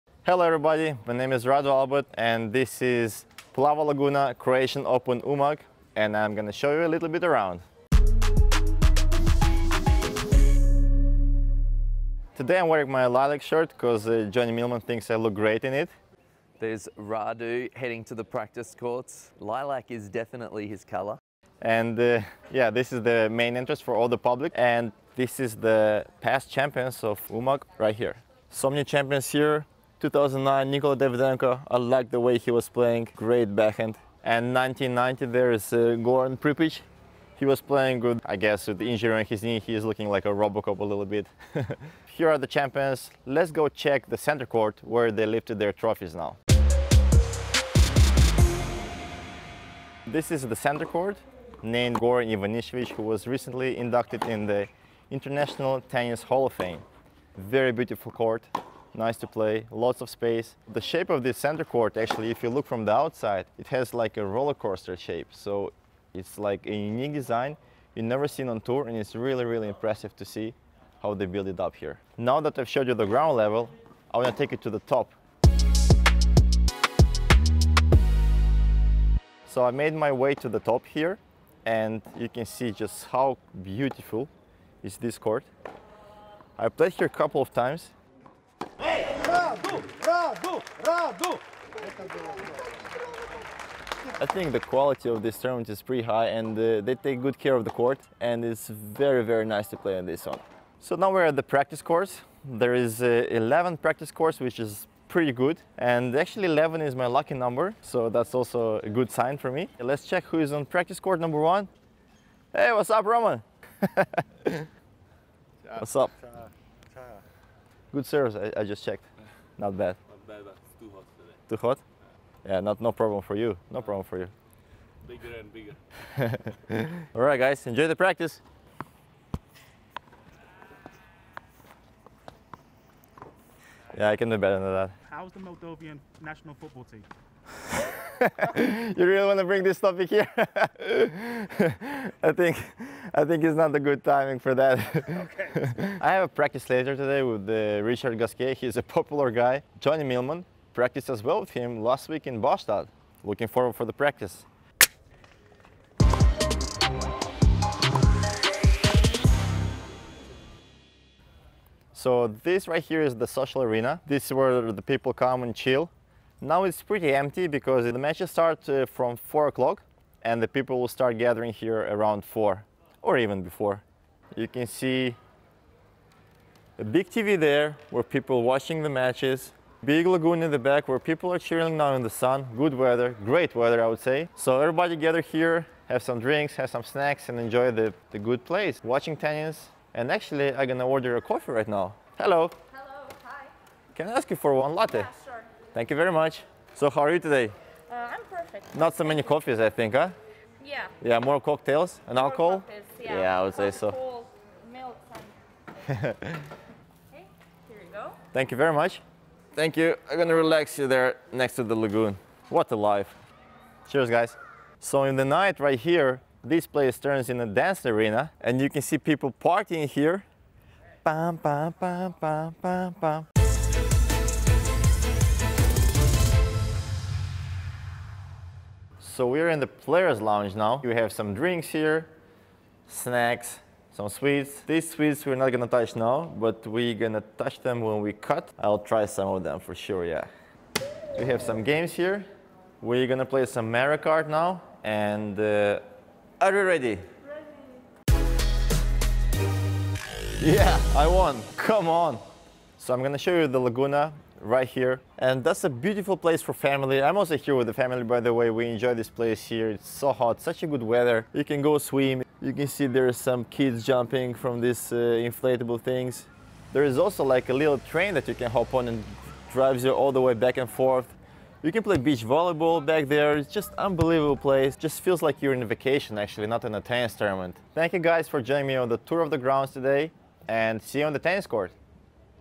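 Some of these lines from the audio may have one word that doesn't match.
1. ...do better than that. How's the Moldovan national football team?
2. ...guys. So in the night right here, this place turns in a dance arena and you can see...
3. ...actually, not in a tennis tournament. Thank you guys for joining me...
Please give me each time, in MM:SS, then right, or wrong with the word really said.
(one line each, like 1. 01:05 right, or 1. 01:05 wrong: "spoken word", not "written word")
1. 02:14 right
2. 03:34 right
3. 04:36 right.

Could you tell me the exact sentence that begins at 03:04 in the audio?
So everybody gather here, have some drinks, have some snacks and enjoy the, the good place, watching tennis.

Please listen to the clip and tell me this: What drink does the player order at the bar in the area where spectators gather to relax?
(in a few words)
Latte.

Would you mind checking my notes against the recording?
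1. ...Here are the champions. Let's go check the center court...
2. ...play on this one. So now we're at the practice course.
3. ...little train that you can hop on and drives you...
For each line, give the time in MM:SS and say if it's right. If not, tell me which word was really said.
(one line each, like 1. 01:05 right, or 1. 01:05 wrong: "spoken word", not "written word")
1. 00:42 right
2. 01:39 right
3. 04:27 right.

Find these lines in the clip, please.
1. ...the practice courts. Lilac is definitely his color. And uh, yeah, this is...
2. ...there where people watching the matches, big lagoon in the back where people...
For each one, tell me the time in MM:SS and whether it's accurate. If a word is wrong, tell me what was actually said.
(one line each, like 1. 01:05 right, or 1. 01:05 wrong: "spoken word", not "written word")
1. 00:18 right
2. 02:57 right.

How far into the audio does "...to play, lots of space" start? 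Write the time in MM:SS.
00:59.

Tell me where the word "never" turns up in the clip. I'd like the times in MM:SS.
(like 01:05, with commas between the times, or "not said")
01:08.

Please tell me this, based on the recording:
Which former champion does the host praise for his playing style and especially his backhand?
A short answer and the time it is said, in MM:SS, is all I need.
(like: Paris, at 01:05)
Nikola Davydenko, at 00:30.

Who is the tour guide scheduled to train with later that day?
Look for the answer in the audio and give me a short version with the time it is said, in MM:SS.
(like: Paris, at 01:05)
Richard Gasquet, at 02:27.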